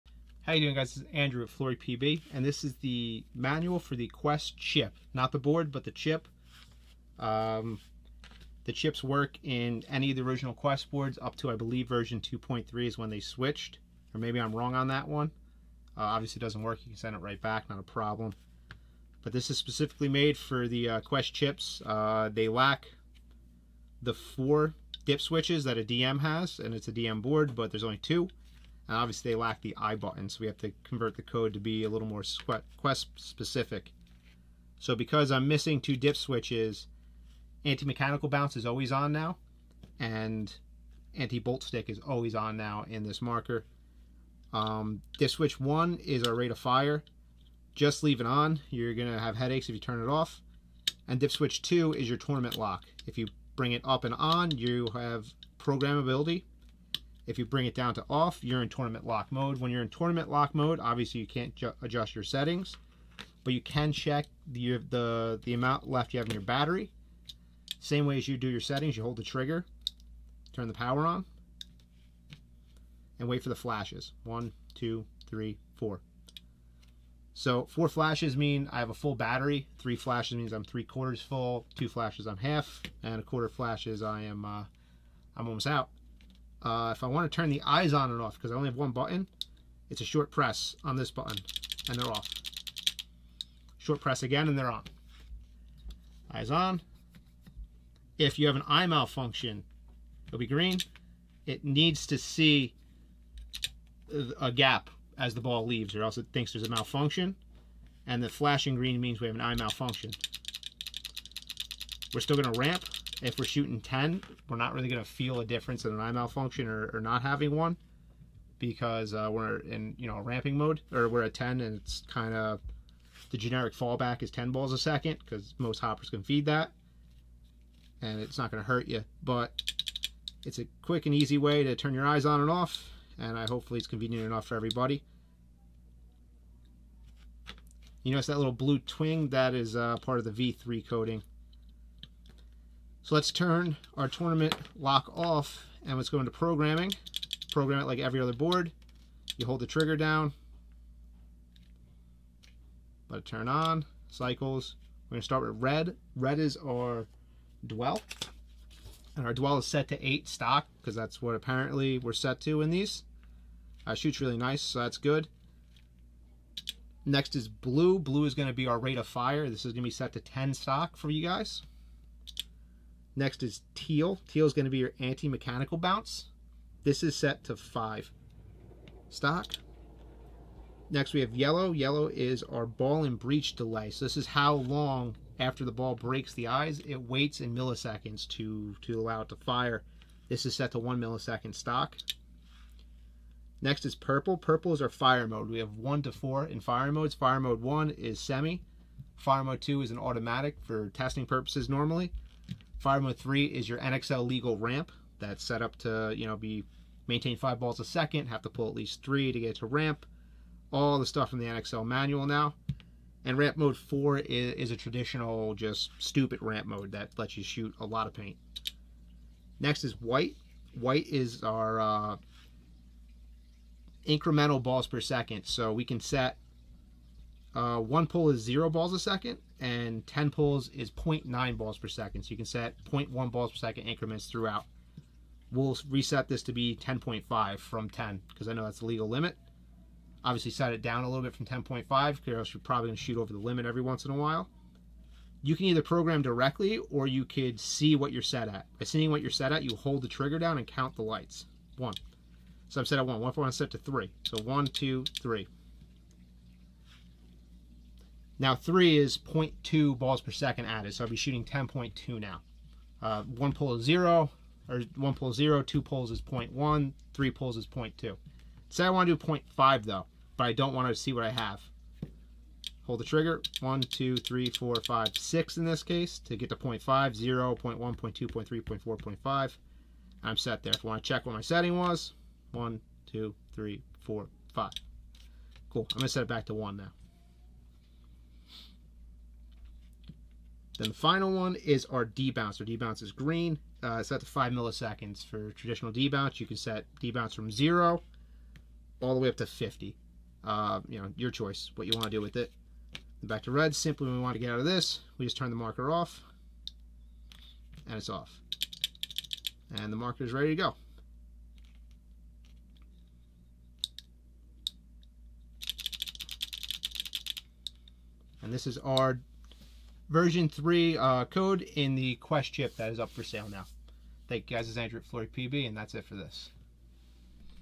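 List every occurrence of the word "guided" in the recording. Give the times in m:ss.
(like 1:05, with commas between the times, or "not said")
not said.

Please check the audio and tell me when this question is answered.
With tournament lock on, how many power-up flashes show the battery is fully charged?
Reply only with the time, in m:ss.
1:17.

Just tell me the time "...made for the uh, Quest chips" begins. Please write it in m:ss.
0:20.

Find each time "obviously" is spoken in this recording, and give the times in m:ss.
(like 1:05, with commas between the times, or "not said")
0:16, 0:28, 1:00, 4:00.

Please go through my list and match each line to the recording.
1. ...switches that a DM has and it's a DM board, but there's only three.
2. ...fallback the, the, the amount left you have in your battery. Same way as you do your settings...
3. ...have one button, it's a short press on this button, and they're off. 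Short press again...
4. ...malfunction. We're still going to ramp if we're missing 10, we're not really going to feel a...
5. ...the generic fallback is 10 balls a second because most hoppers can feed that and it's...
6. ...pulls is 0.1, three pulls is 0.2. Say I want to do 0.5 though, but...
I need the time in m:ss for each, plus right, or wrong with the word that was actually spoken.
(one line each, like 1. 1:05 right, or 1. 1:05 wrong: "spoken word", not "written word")
1. 0:25 wrong: "two", not "three"
2. 1:03 wrong: "check", not "fallback"
3. 1:28 right
4. 1:49 wrong: "shooting", not "missing"
5. 2:03 right
6. 4:25 right.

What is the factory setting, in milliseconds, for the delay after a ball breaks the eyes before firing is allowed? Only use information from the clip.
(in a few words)
1 millisecond.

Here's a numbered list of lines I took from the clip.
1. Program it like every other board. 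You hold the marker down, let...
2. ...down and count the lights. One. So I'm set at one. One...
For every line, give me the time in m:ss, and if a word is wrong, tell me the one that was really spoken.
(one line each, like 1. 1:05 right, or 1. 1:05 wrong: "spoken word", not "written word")
1. 2:27 wrong: "trigger", not "marker"
2. 4:10 right.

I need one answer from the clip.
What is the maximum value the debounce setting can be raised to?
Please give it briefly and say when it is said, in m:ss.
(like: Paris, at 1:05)
50, at 4:59.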